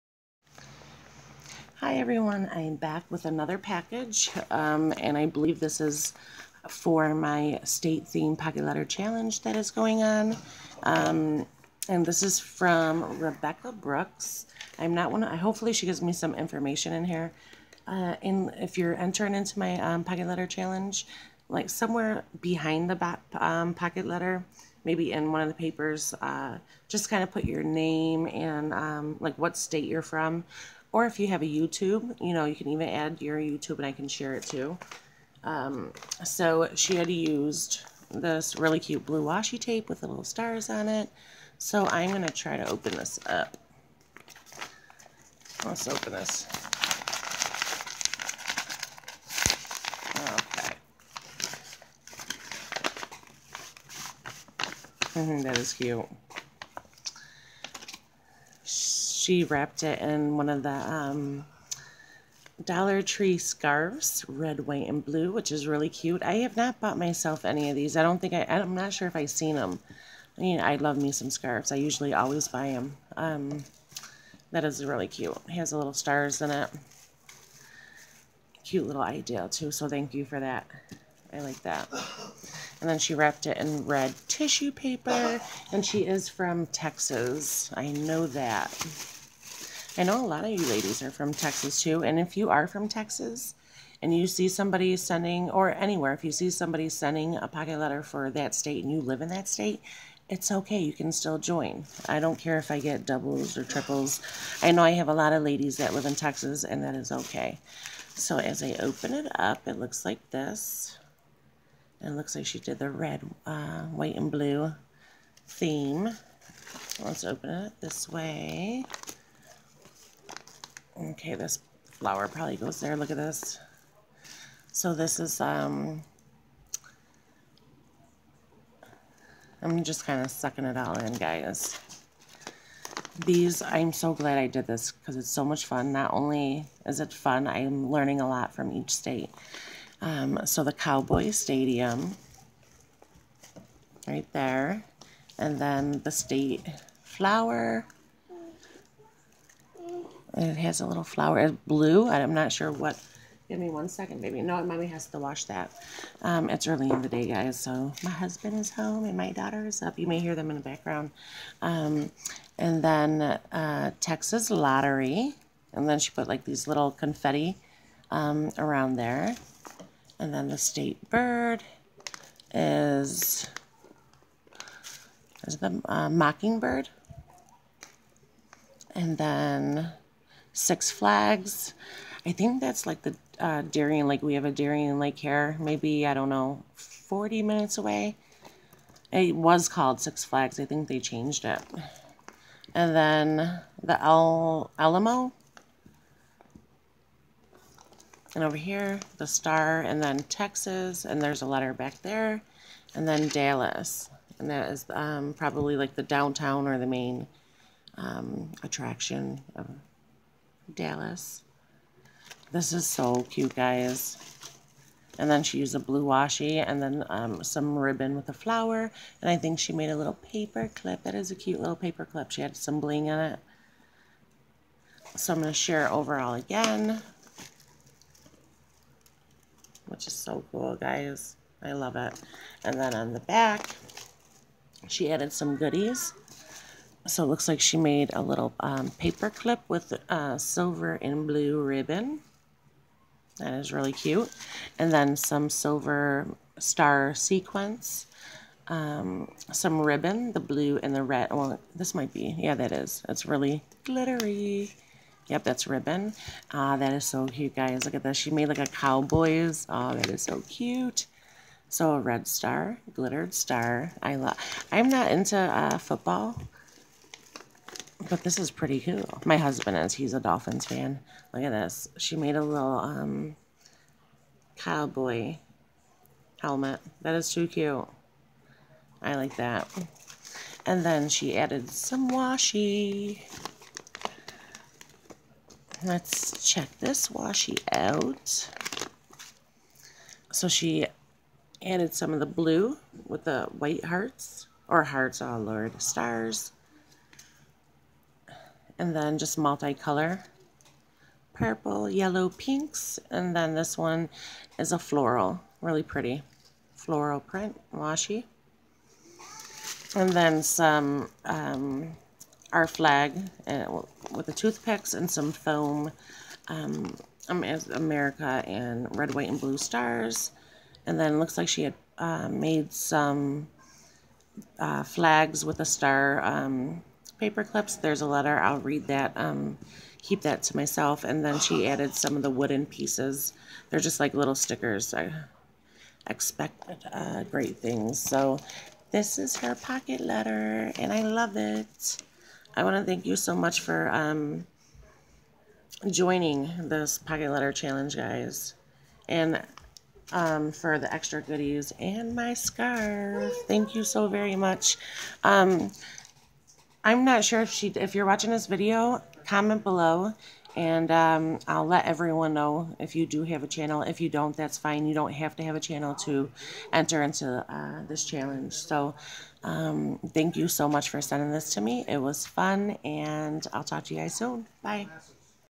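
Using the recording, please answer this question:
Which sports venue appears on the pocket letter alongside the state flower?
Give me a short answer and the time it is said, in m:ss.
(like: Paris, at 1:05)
Cowboy Stadium, at 2:20.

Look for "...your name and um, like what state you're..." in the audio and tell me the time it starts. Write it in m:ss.
0:27.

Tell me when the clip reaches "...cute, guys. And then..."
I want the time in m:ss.
3:33.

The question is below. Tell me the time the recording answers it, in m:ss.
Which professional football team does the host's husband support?
4:30.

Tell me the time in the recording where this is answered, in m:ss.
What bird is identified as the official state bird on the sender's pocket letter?
2:56.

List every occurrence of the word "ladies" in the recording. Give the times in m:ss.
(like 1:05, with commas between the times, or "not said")
1:30, 1:45.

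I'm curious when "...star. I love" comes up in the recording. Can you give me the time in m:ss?
4:23.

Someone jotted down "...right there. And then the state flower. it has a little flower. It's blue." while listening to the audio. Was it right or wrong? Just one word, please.
right.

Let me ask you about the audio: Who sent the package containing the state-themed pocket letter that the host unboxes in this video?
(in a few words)
Rebecca Brooks.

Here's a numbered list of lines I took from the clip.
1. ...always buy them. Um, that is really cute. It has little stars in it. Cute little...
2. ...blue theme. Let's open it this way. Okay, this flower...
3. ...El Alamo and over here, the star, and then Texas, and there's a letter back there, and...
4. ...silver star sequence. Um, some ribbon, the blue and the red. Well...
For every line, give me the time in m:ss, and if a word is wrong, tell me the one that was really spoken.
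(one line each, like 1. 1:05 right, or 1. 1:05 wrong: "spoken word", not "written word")
1. 1:12 right
2. 1:54 right
3. 3:14 right
4. 4:05 right.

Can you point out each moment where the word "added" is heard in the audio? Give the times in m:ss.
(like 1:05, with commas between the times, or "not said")
3:55, 4:41, 4:51, 5:31.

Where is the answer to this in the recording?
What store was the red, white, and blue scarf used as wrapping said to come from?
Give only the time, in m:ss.
1:02.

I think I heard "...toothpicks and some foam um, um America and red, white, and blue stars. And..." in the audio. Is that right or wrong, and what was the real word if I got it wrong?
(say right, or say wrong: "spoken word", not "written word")
right.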